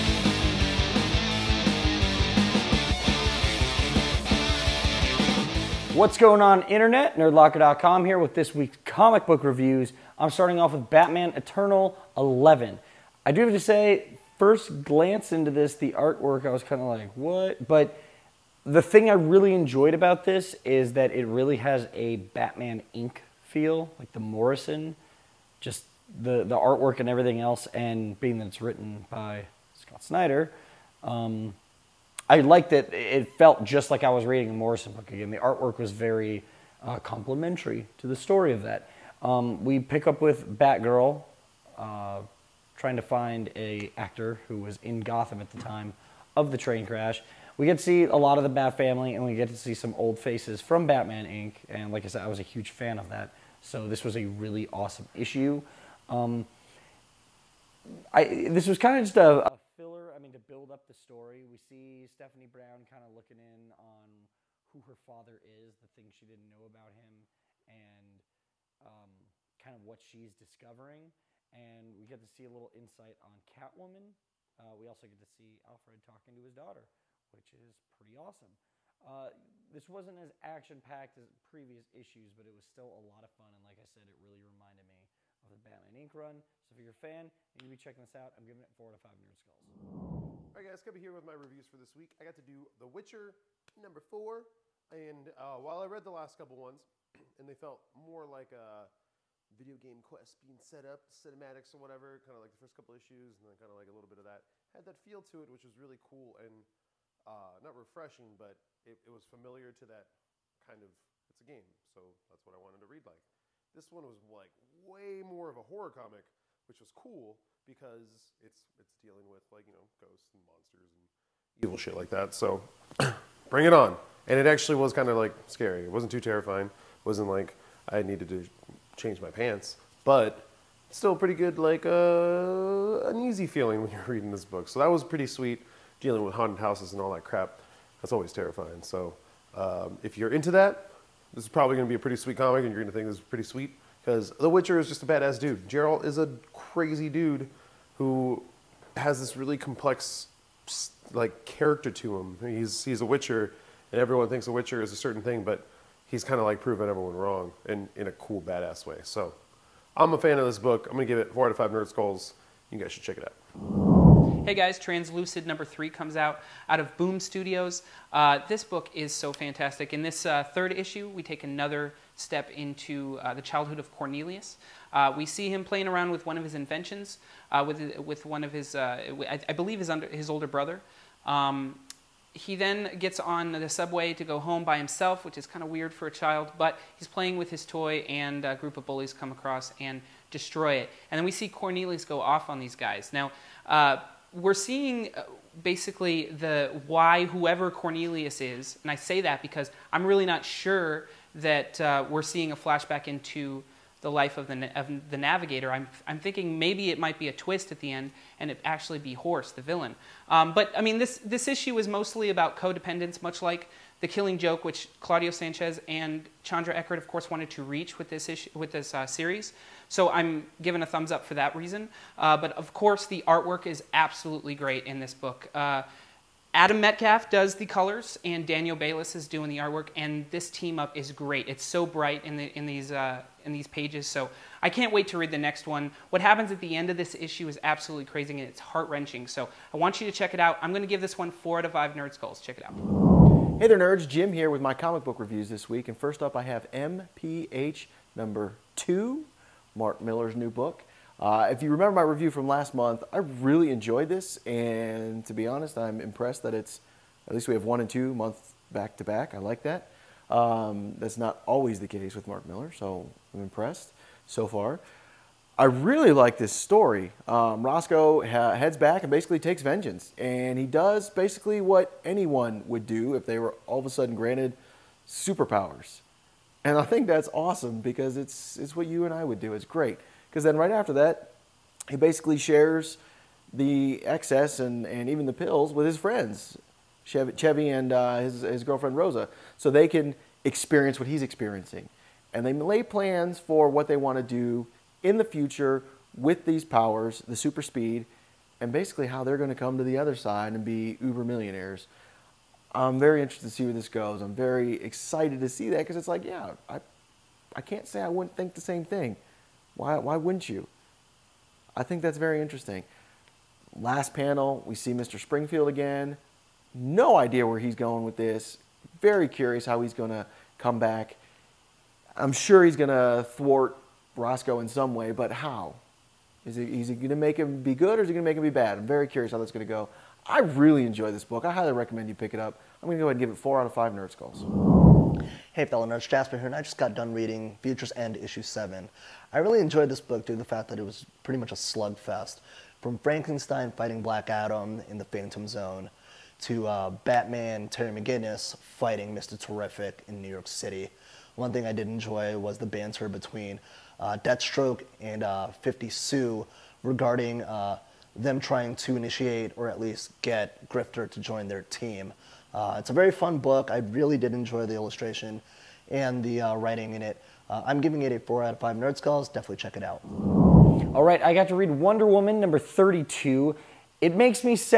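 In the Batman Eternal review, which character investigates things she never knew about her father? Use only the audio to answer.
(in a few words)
Stephanie Brown.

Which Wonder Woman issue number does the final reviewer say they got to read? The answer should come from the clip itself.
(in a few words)
32.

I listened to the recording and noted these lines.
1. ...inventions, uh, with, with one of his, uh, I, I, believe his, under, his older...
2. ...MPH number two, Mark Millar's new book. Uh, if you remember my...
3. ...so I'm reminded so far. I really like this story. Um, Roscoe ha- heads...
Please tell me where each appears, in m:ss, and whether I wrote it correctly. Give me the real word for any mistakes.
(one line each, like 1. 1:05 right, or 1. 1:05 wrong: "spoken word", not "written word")
1. 2:56 right
2. 4:06 right
3. 4:22 wrong: "impressed", not "reminded".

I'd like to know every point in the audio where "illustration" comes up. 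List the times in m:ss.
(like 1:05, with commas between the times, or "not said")
6:04.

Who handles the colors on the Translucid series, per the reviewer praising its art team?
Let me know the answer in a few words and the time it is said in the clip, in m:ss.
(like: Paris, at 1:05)
Adam Metcalfe, at 3:46.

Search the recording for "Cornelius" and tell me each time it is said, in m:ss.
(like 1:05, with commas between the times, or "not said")
2:53, 3:11, 3:17.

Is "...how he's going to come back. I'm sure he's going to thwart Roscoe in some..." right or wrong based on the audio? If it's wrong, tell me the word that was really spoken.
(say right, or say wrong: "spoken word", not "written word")
right.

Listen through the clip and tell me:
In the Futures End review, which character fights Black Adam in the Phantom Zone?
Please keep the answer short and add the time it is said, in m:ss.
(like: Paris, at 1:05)
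Frankenstein, at 5:42.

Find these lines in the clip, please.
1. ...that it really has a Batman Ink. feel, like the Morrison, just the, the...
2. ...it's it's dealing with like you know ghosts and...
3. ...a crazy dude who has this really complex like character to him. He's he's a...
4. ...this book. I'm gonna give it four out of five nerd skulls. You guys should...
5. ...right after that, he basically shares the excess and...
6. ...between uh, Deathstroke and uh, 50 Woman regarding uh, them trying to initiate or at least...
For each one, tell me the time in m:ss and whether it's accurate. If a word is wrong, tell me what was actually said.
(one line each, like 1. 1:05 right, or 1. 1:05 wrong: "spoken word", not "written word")
1. 0:20 wrong: "Inc", not "Ink"
2. 1:58 right
3. 2:26 right
4. 2:40 right
5. 4:40 right
6. 5:53 wrong: "Sue", not "Woman".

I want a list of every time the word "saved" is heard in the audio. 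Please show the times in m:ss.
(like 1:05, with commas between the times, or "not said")
not said.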